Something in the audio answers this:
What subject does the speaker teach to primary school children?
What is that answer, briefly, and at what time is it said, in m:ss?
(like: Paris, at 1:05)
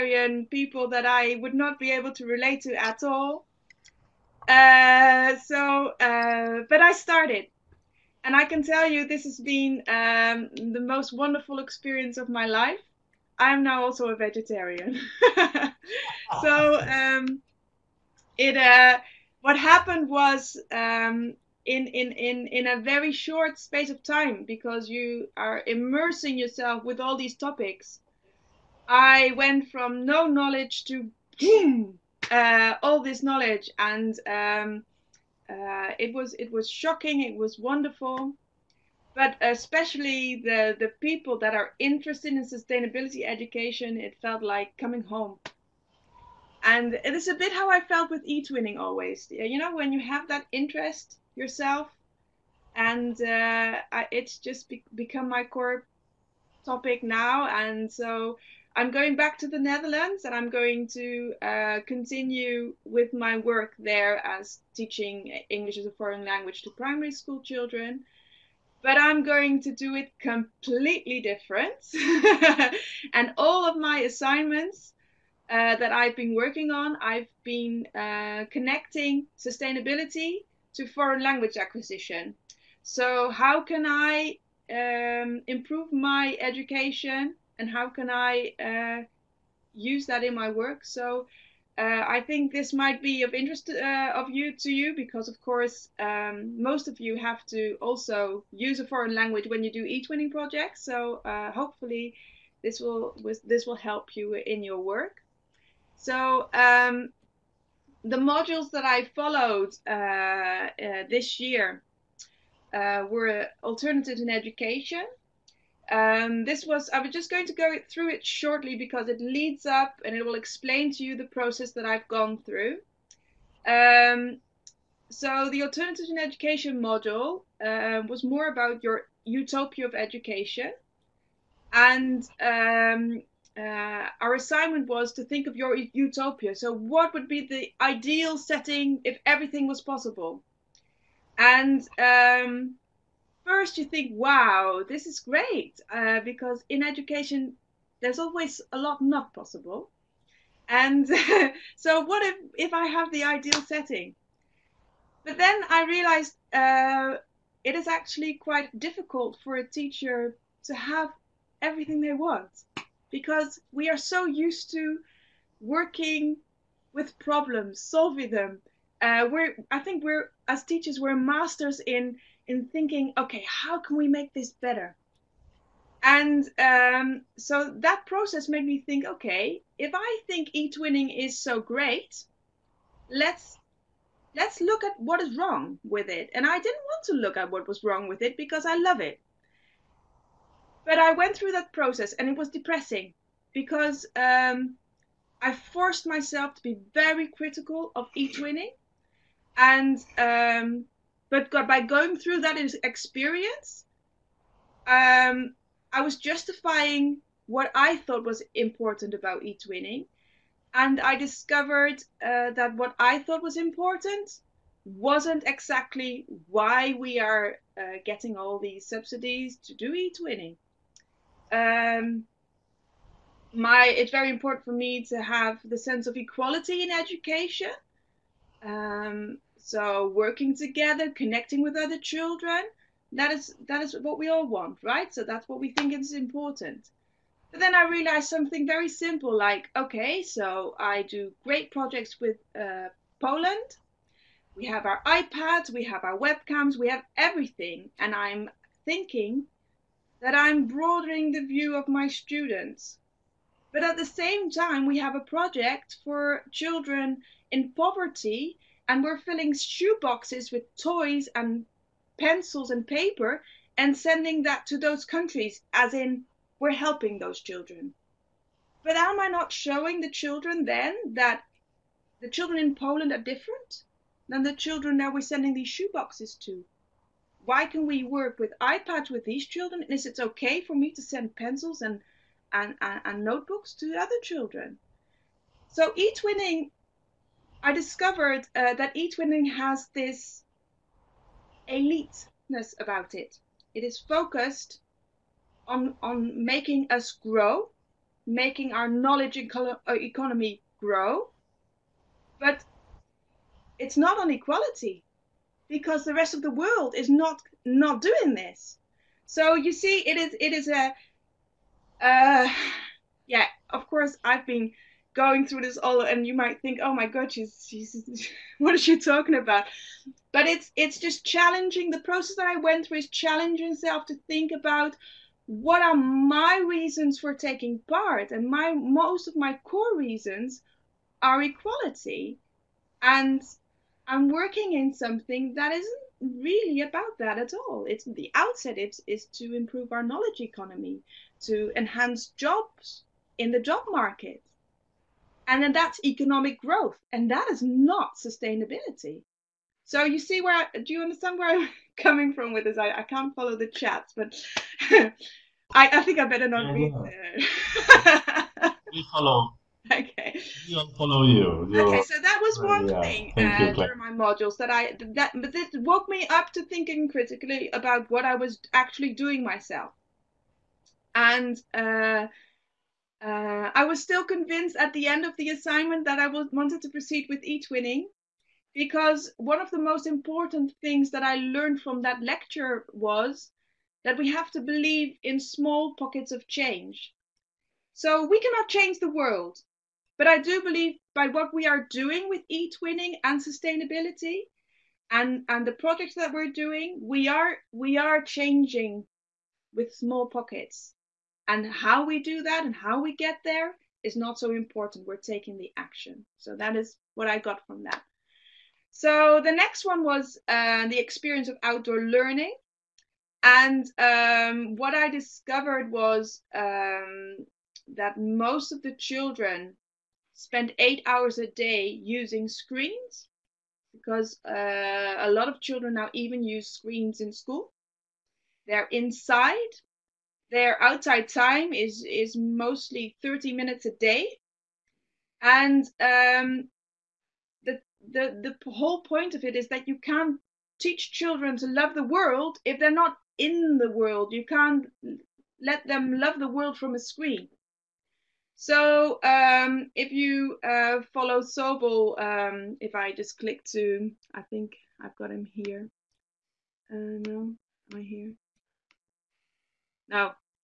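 English as a foreign language, at 1:05.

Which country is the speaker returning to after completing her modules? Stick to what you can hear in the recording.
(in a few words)
The Netherlands.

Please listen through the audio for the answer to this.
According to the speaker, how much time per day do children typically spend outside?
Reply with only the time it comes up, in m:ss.
7:13.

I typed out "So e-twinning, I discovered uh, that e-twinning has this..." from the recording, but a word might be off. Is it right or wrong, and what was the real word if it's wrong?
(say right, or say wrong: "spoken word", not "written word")
right.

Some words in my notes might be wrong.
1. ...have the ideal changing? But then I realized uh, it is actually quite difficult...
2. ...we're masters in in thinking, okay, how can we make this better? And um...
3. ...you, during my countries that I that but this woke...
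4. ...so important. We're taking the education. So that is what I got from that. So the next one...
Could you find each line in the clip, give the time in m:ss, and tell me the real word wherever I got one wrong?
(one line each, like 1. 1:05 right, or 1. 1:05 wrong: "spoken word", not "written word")
1. 2:32 wrong: "setting", not "changing"
2. 2:50 right
3. 6:03 wrong: "modules", not "countries"
4. 6:44 wrong: "action", not "education".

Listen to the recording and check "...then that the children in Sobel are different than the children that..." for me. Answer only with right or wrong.
wrong.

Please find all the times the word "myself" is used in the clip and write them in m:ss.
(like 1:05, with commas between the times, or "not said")
3:16, 6:09.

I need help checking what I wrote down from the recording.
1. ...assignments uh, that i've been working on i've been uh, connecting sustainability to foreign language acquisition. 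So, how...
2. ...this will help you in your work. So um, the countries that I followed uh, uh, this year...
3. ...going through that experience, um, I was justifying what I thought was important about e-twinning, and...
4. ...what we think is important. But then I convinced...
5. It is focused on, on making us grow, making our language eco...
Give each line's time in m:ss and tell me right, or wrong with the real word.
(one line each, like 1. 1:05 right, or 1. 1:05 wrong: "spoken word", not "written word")
1. 1:13 right
2. 1:43 wrong: "modules", not "countries"
3. 3:21 right
4. 3:55 wrong: "realized", not "convinced"
5. 4:53 wrong: "knowledge", not "language".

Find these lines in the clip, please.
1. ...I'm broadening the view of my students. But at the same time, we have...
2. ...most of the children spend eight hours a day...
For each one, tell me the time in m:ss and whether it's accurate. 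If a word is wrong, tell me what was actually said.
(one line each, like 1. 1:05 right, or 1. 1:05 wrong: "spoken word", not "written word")
1. 4:10 right
2. 6:58 right.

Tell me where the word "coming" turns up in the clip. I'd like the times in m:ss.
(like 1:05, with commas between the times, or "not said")
0:44, 5:52.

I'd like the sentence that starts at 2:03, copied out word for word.
Um, so the alternatives in education module uh, was more about your utopia of education.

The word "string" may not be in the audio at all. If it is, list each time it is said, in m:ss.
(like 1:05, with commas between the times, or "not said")
not said.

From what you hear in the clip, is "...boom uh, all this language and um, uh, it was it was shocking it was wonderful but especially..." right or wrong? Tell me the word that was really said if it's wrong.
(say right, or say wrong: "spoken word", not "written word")
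wrong: "knowledge", not "language".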